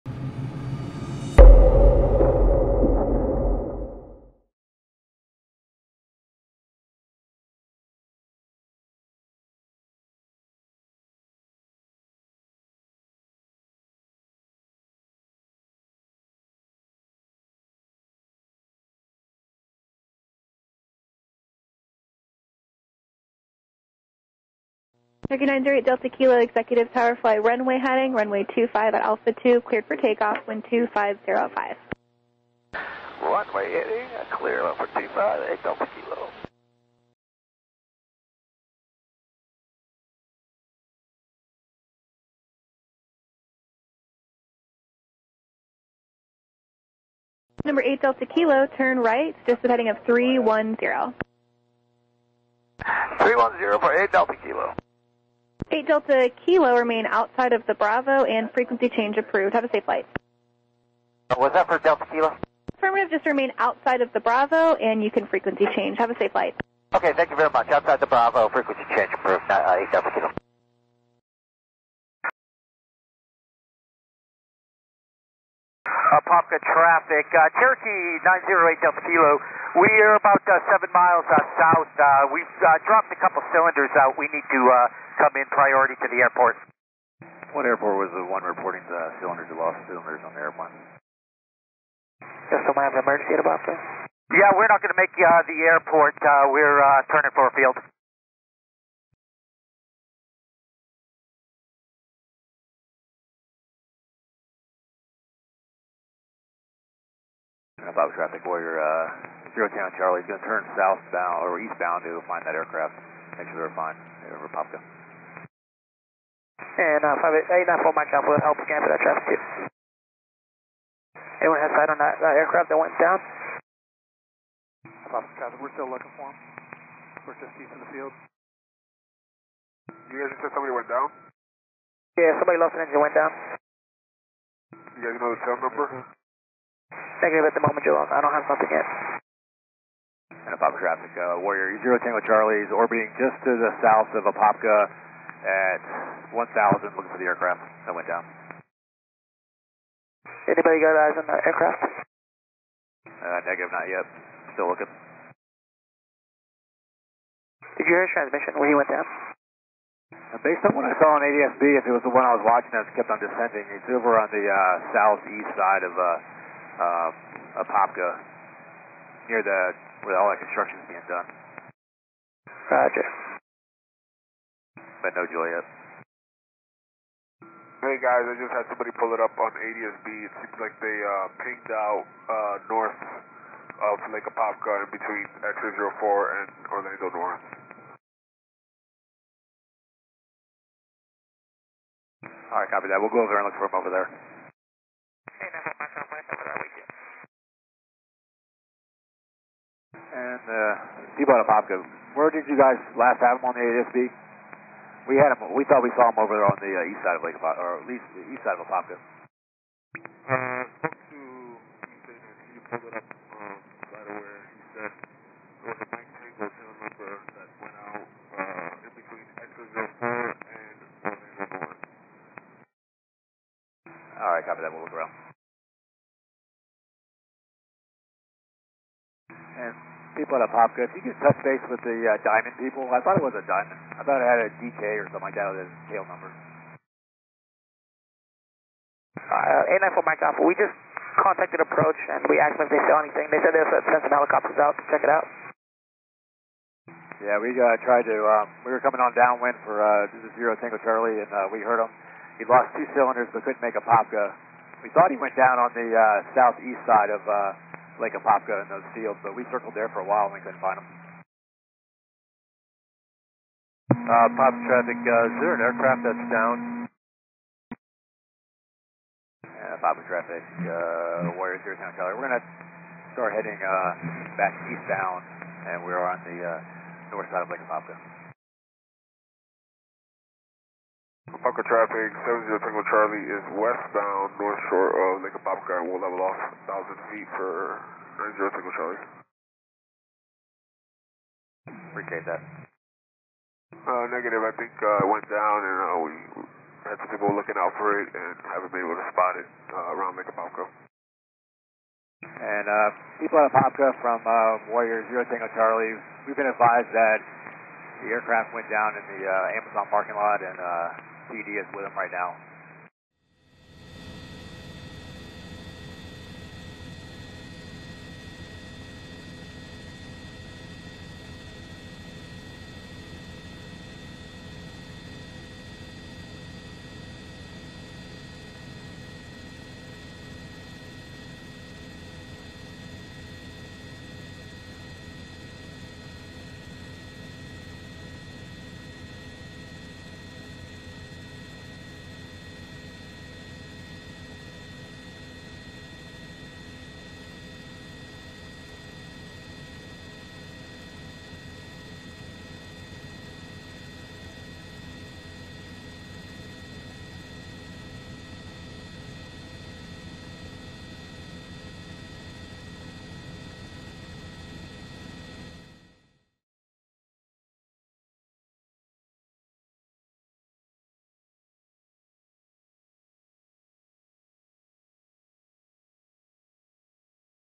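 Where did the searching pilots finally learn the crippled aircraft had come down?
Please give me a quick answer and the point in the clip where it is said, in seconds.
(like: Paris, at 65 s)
Amazon parking lot, at 309 s.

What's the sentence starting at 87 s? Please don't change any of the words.
What airport was the one reporting the cylinders, the lost cylinders on the airplane?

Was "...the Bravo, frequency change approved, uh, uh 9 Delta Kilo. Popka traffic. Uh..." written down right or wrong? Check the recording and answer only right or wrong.
wrong.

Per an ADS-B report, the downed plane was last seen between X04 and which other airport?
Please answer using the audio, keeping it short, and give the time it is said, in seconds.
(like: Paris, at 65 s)
Orlando North, at 186 s.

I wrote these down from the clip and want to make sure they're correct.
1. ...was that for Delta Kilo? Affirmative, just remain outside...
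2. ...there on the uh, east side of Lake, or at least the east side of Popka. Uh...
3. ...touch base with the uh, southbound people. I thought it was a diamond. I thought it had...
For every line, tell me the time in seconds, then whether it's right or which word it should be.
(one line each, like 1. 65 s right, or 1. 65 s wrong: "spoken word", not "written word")
1. 61 s right
2. 206 s right
3. 231 s wrong: "diamond", not "southbound".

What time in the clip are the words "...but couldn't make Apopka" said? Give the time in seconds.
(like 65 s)
253 s.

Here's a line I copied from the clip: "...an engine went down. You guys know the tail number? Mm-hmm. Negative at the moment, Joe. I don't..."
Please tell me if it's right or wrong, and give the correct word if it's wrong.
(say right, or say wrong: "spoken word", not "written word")
right.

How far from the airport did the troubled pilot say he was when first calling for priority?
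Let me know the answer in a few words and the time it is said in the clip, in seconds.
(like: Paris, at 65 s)
7 miles, at 80 s.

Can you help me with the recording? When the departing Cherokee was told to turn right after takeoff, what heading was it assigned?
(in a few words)
310.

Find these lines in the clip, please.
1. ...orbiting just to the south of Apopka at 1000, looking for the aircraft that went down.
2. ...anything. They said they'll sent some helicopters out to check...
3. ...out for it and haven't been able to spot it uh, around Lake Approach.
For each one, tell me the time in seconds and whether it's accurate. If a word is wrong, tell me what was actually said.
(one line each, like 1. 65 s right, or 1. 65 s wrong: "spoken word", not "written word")
1. 142 s right
2. 243 s right
3. 297 s wrong: "Apopka", not "Approach".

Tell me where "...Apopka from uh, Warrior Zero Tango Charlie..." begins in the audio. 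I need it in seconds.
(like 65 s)
303 s.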